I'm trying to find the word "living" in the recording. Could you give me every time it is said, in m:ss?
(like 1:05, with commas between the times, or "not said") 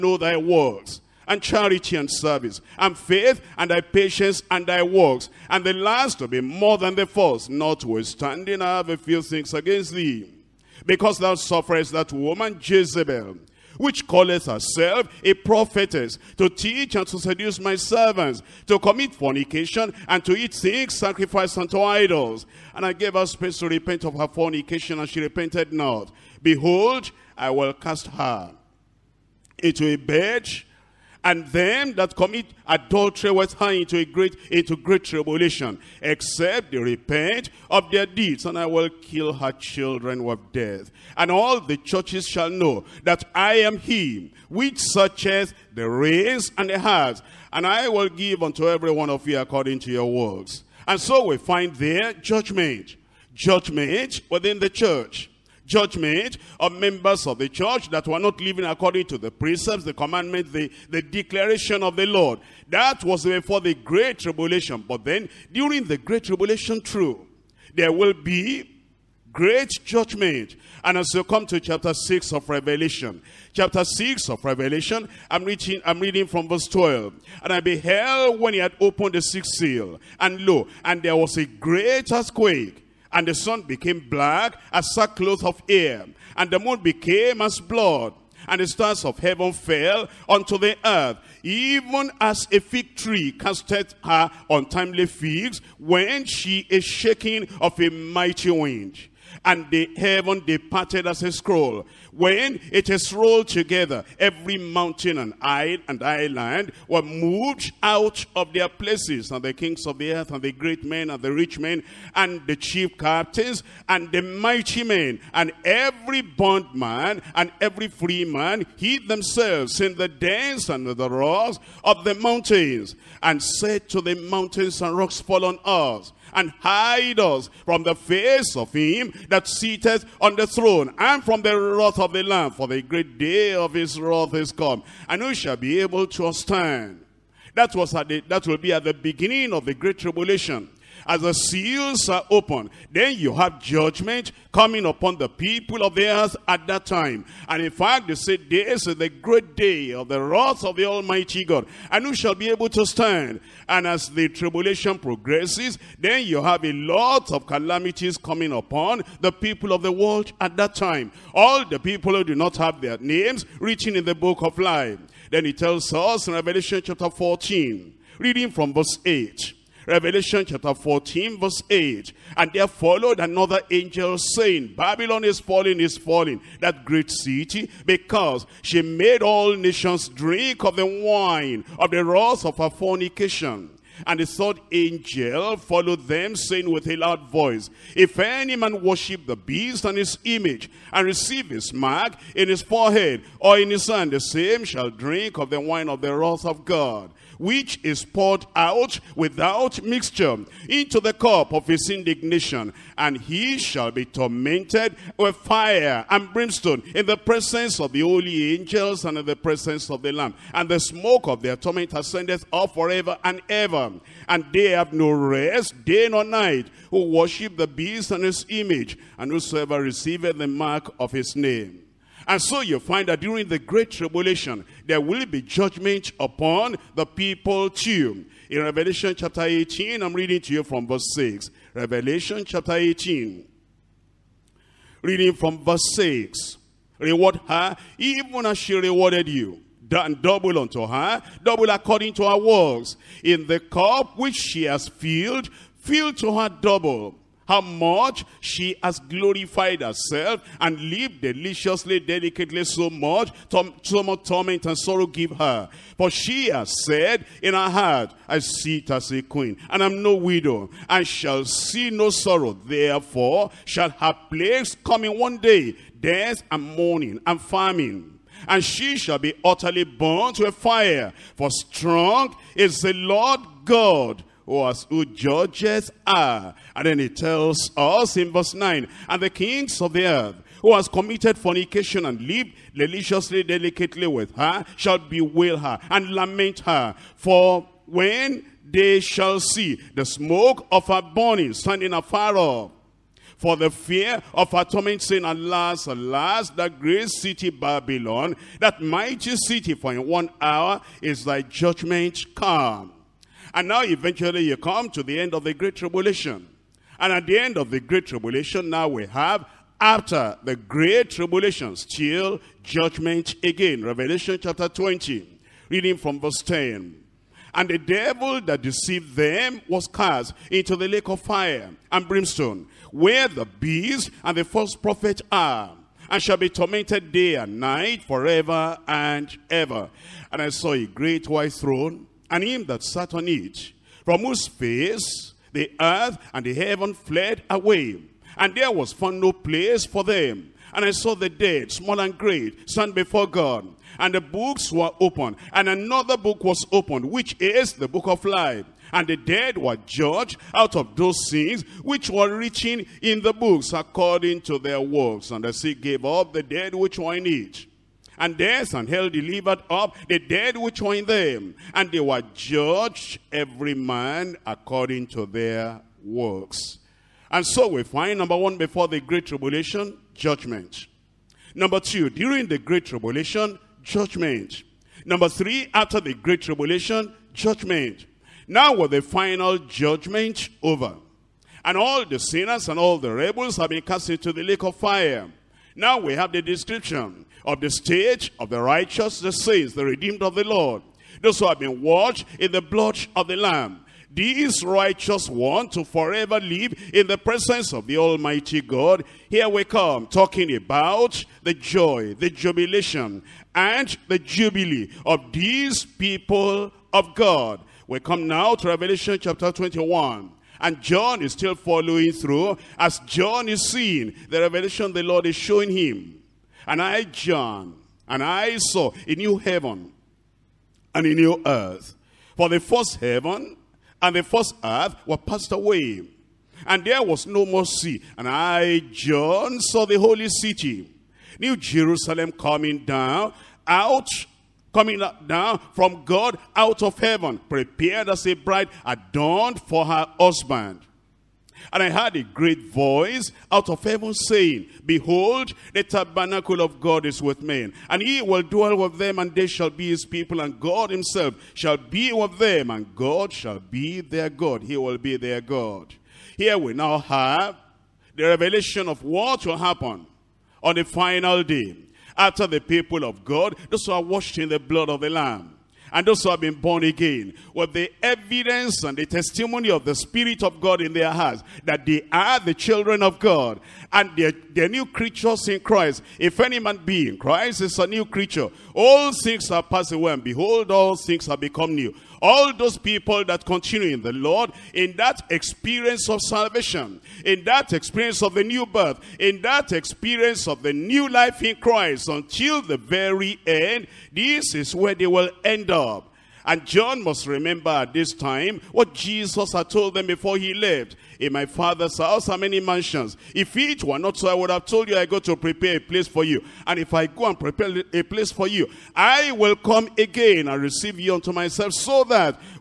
0:58.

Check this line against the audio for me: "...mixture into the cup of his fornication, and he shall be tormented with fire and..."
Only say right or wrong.
wrong.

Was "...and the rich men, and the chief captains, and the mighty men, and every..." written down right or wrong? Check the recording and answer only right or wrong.
right.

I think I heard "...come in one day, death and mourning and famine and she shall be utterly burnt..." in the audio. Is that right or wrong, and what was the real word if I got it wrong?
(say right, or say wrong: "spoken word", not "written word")
right.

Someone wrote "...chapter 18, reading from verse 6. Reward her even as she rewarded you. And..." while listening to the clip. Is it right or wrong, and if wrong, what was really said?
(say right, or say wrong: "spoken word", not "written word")
right.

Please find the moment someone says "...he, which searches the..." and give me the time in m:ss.
0:43.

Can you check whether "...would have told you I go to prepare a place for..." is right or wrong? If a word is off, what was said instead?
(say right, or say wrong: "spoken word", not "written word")
right.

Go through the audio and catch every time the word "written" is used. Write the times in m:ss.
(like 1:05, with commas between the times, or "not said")
2:43, 5:52.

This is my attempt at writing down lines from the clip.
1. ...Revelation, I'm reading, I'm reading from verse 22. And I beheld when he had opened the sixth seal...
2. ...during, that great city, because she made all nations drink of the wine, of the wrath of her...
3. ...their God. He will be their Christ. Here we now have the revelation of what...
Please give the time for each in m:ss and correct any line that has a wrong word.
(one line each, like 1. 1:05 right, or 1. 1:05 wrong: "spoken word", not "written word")
1. 1:14 wrong: "12", not "22"
2. 2:55 wrong: "falling", not "during"
3. 7:34 wrong: "God", not "Christ".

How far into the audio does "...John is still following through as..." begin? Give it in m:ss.
6:50.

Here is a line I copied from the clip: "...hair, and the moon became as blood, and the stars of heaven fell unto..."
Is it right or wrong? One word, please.
right.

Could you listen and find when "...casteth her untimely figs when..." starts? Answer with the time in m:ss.
1:33.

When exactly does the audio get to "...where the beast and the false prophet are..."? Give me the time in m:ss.
5:22.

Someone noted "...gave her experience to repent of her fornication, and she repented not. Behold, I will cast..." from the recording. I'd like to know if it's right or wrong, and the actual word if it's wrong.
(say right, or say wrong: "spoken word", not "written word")
wrong: "space", not "experience".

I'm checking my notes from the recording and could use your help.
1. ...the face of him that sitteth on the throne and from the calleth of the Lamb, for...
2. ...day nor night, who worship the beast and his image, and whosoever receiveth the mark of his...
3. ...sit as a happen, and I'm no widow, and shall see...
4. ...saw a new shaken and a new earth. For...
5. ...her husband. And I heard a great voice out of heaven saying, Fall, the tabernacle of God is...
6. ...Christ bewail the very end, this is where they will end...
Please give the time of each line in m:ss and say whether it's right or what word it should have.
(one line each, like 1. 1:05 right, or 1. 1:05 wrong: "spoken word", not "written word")
1. 2:07 wrong: "wrath", not "calleth"
2. 3:35 right
3. 4:18 wrong: "queen", not "happen"
4. 6:58 wrong: "heaven", not "shaken"
5. 7:19 wrong: "Behold", not "Fall"
6. 8:11 wrong: "until", not "bewail".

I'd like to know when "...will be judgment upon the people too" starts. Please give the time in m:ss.
3:45.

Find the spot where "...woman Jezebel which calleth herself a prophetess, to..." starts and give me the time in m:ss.
0:12.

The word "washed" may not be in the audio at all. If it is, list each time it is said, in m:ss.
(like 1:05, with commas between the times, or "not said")
6:31, 7:44.